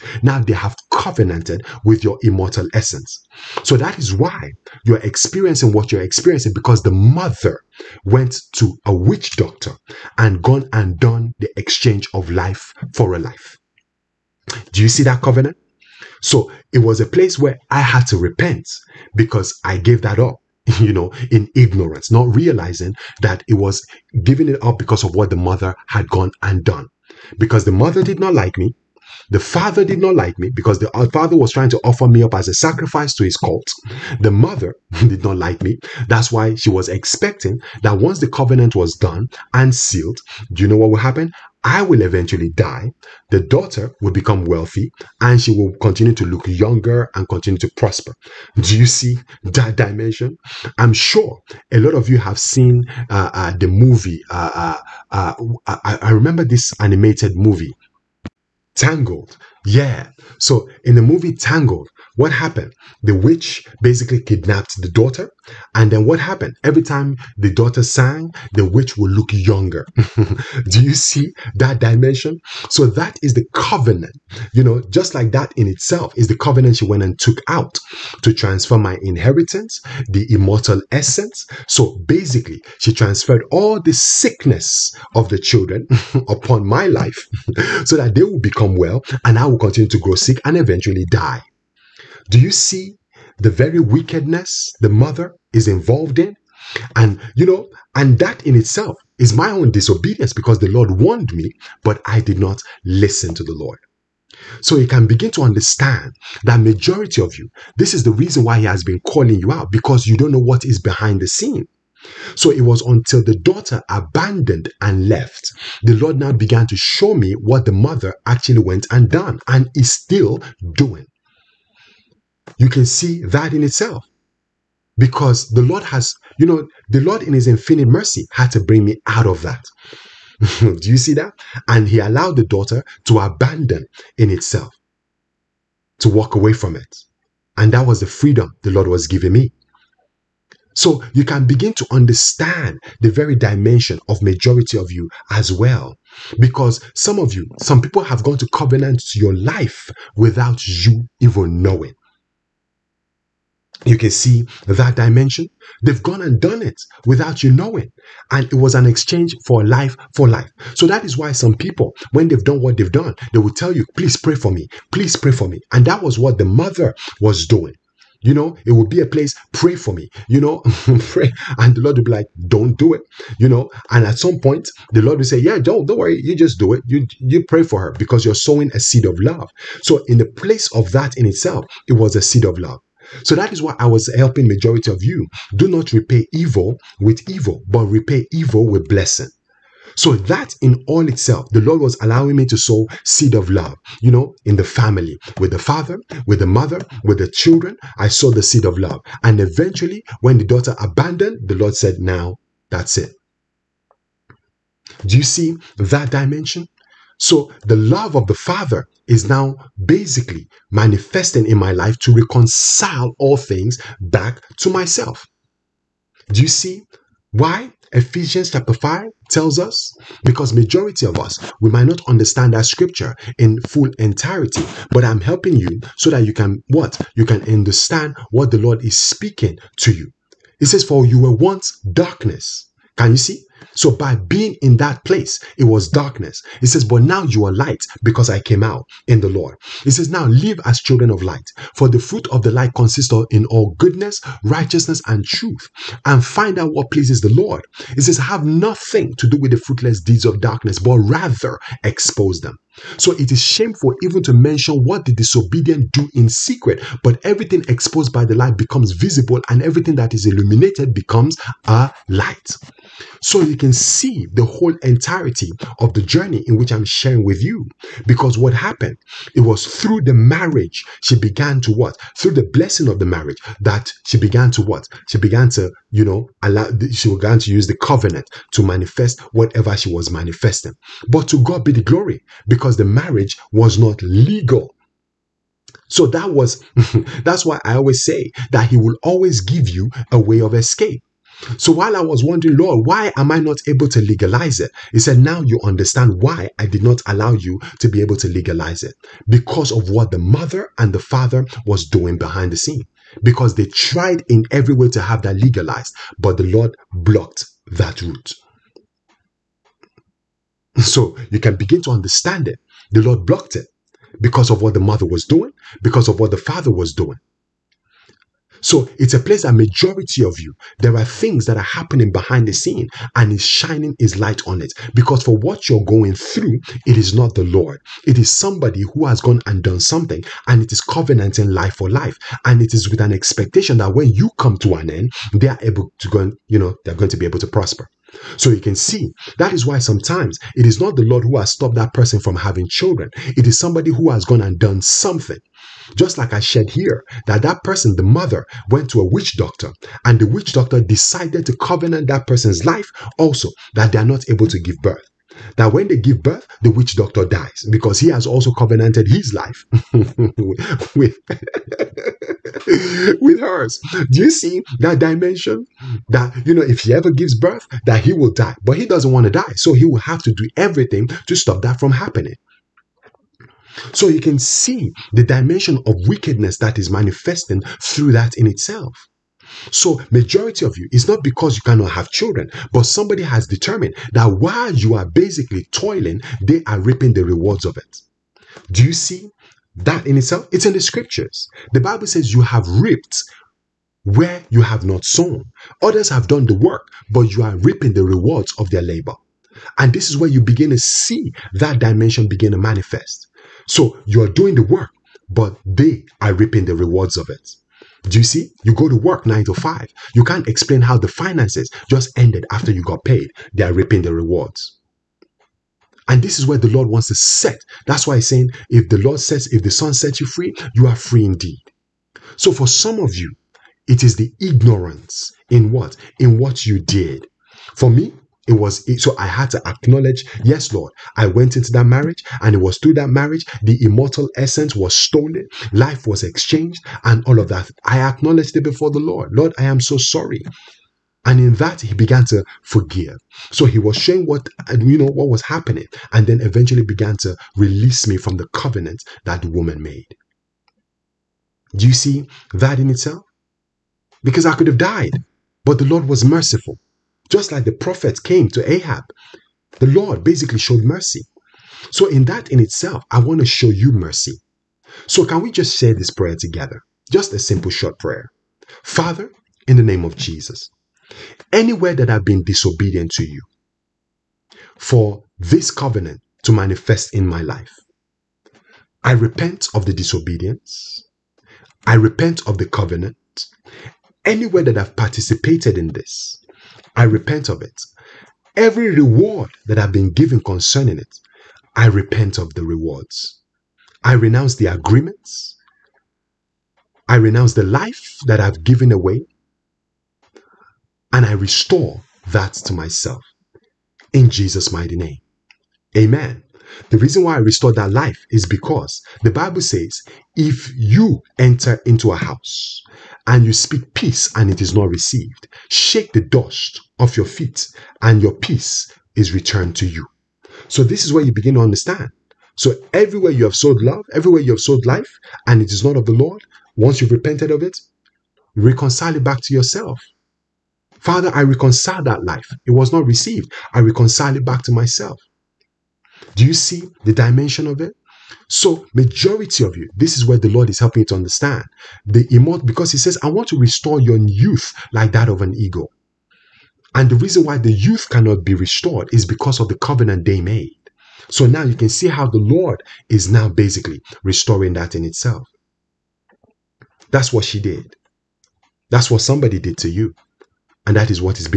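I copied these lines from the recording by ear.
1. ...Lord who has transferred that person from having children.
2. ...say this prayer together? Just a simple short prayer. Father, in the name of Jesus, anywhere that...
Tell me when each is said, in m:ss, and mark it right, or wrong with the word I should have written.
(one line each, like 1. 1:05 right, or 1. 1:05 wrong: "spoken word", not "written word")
1. 5:41 wrong: "stopped", not "transferred"
2. 7:45 right.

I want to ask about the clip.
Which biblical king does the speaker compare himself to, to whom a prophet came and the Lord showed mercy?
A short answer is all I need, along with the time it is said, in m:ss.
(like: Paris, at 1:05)
Ahab, at 7:38.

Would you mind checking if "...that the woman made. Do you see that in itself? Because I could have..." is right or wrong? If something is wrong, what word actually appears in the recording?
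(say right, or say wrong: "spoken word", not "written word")
right.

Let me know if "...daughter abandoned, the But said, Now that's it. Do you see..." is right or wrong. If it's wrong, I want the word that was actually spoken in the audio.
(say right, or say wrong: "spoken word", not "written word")
wrong: "Lord", not "But".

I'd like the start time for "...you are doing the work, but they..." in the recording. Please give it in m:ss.
6:44.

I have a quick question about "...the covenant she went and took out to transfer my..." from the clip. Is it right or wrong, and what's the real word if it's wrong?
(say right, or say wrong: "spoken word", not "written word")
right.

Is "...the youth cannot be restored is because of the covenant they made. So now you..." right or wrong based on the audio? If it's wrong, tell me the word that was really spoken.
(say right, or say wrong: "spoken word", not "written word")
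right.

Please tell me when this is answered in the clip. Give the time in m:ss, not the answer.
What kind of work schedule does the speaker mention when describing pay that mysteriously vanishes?
6:49.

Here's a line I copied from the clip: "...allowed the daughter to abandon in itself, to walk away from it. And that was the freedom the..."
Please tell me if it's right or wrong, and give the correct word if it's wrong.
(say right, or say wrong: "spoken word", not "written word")
right.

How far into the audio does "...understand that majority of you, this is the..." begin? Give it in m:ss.
1:45.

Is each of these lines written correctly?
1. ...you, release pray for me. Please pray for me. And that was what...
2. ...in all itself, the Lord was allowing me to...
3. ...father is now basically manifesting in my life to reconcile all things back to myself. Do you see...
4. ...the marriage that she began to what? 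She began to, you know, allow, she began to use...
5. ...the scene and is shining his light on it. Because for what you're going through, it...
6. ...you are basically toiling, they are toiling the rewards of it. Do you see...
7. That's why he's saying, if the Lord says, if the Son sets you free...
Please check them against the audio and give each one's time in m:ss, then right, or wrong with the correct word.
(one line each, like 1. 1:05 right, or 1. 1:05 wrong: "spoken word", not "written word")
1. 2:43 wrong: "please", not "release"
2. 3:10 right
3. 3:28 right
4. 4:32 right
5. 5:22 right
6. 6:24 wrong: "reaping", not "toiling"
7. 6:57 right.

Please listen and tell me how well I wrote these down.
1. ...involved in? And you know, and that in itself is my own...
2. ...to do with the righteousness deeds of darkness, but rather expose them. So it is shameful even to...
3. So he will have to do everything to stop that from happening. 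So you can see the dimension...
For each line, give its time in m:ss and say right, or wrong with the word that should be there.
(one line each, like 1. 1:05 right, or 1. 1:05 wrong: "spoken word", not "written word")
1. 1:35 right
2. 4:09 wrong: "fruitless", not "righteousness"
3. 6:09 right.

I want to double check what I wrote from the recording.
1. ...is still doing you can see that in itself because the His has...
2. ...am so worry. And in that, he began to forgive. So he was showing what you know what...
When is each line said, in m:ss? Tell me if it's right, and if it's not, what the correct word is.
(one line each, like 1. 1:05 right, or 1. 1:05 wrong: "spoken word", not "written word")
1. 1:59 wrong: "Lord", not "His"
2. 7:19 wrong: "sorry", not "worry".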